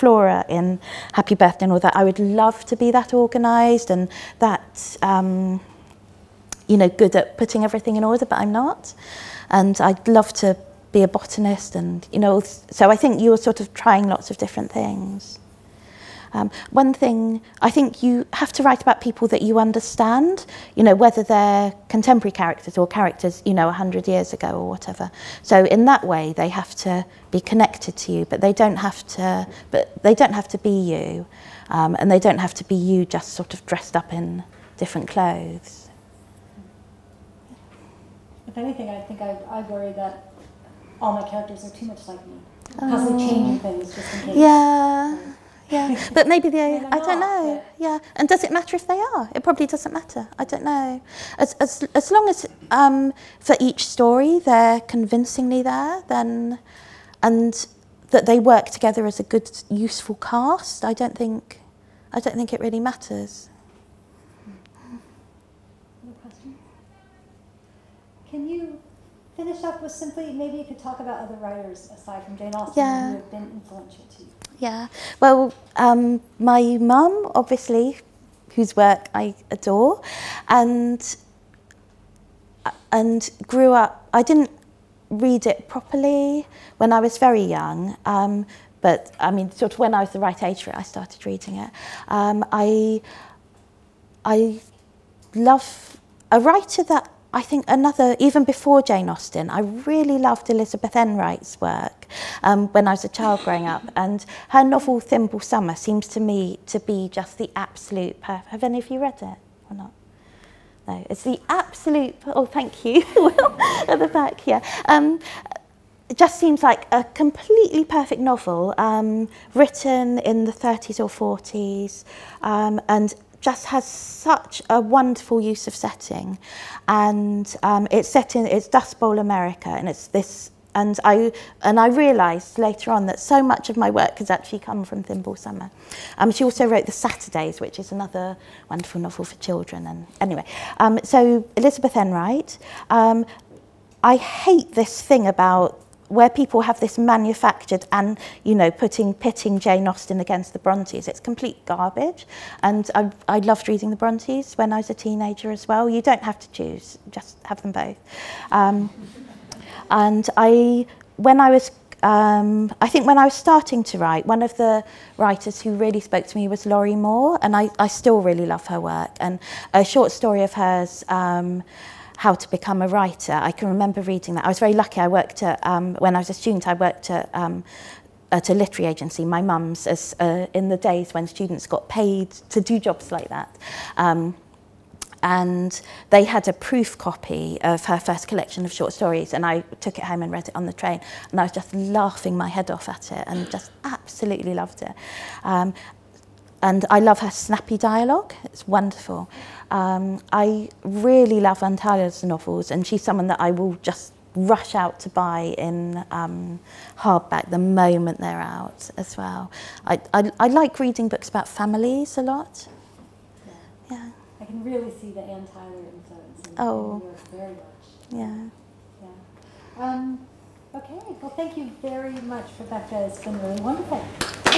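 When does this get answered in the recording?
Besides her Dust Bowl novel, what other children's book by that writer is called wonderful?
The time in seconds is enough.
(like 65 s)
136 s.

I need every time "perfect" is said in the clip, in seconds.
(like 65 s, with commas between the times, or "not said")
108 s, 117 s.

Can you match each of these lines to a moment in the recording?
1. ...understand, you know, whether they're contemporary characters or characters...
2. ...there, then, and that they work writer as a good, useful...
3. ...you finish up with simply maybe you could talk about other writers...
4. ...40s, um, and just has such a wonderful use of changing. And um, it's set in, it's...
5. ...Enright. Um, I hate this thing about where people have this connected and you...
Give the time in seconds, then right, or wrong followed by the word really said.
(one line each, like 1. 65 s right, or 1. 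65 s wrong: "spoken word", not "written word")
1. 19 s right
2. 55 s wrong: "together", not "writer"
3. 68 s right
4. 121 s wrong: "setting", not "changing"
5. 141 s wrong: "manufactured", not "connected".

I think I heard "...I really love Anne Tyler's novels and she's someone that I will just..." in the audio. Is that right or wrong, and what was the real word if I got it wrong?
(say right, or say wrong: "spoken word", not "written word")
right.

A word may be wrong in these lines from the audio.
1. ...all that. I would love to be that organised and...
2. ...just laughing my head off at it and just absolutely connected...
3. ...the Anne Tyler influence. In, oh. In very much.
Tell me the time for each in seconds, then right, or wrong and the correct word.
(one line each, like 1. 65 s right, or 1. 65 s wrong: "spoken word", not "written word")
1. 1 s right
2. 191 s wrong: "loved", not "connected"
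3. 215 s right.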